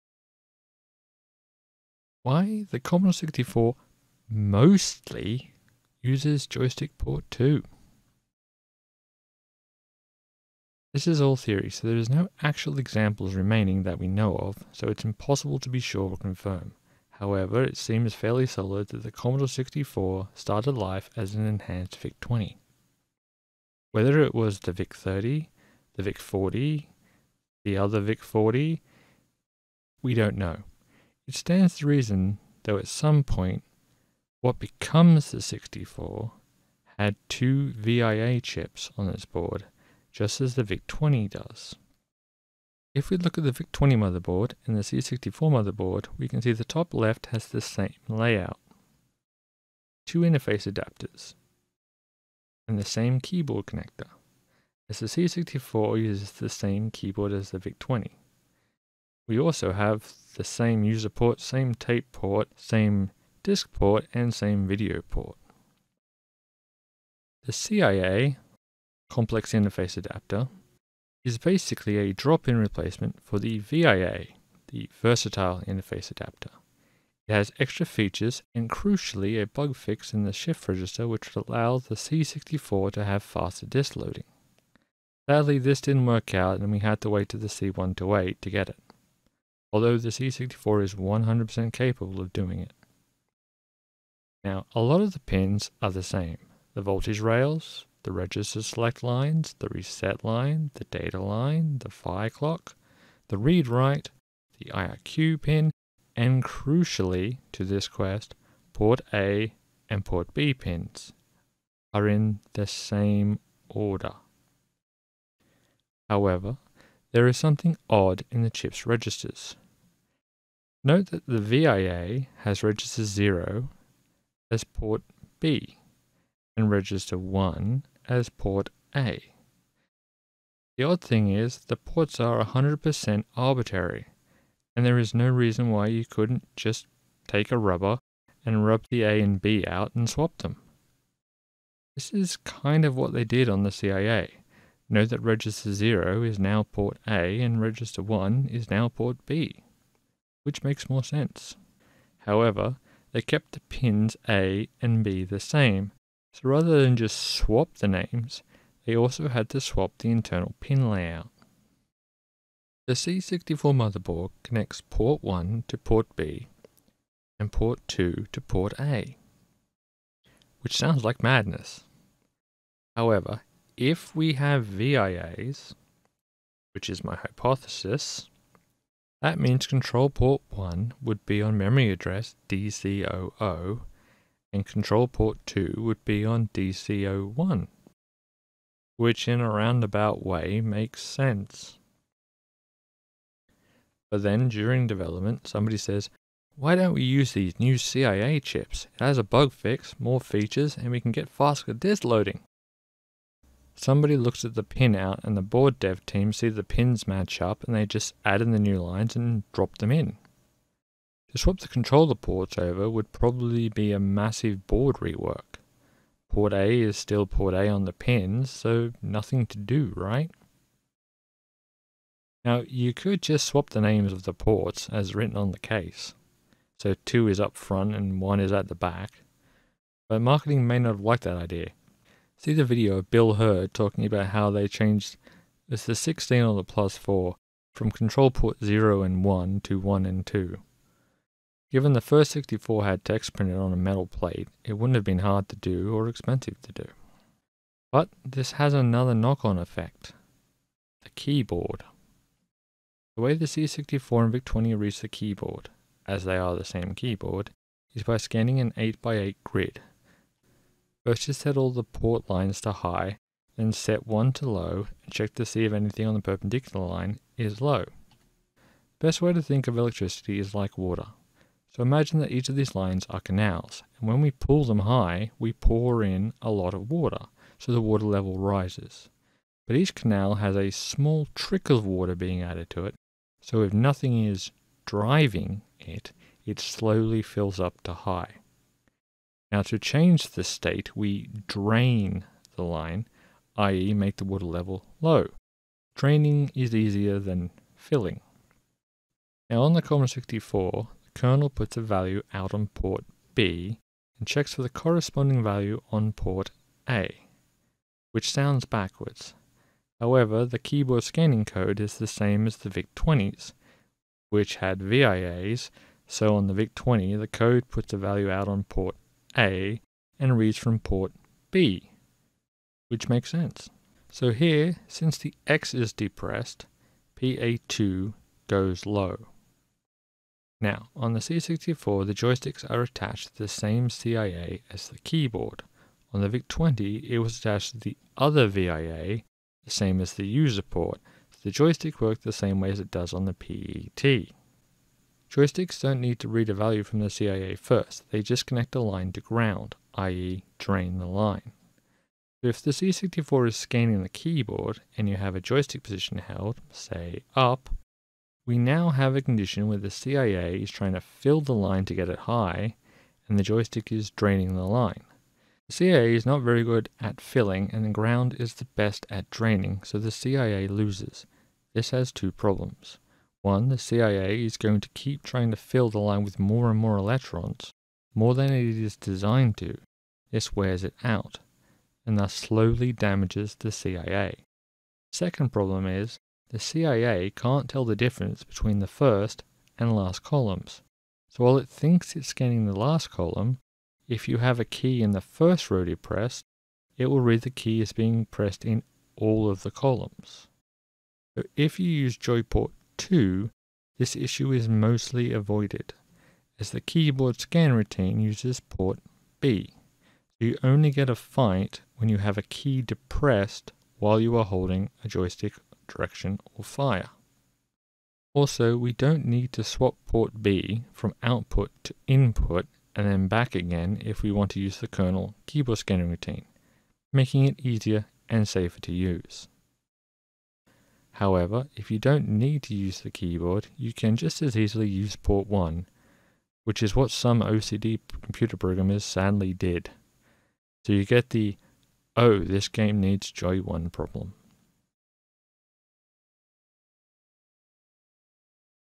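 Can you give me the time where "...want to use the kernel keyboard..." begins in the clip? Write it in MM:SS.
07:04.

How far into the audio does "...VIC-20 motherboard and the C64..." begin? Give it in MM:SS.
00:43.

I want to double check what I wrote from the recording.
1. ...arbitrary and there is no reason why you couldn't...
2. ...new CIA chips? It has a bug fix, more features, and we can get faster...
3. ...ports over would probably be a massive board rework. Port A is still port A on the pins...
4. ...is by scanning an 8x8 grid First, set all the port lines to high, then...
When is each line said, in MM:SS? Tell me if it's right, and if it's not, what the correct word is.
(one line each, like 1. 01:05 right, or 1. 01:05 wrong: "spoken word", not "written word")
1. 02:13 right
2. 03:17 right
3. 03:32 right
4. 04:17 right.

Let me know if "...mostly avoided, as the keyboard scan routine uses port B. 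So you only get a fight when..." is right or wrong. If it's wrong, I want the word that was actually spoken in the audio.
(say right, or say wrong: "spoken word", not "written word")
right.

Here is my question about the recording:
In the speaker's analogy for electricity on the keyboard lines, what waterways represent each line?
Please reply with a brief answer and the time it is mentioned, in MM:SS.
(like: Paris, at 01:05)
canals, at 04:33.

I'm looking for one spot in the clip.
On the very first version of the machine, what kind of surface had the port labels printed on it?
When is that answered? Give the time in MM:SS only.
04:03.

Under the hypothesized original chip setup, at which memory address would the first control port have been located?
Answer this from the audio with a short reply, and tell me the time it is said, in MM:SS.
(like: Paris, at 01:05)
DC00, at 03:02.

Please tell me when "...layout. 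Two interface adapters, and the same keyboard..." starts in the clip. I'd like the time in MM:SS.
00:48.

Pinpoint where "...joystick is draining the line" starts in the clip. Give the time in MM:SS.
06:03.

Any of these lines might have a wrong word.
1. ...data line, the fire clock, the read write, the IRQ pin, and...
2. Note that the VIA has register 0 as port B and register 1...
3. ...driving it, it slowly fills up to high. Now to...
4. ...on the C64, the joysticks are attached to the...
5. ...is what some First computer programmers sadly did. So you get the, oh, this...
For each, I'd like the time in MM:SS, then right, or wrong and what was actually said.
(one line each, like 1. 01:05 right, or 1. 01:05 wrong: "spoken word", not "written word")
1. 01:40 right
2. 02:00 right
3. 04:44 right
4. 05:30 right
5. 07:16 wrong: "OCD", not "First".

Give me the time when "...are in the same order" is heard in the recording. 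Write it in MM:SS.
01:51.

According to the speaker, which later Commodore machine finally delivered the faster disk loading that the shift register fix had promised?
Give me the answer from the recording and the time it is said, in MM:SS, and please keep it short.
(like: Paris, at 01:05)
C128, at 01:27.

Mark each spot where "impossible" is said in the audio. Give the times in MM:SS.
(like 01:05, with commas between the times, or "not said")
00:15.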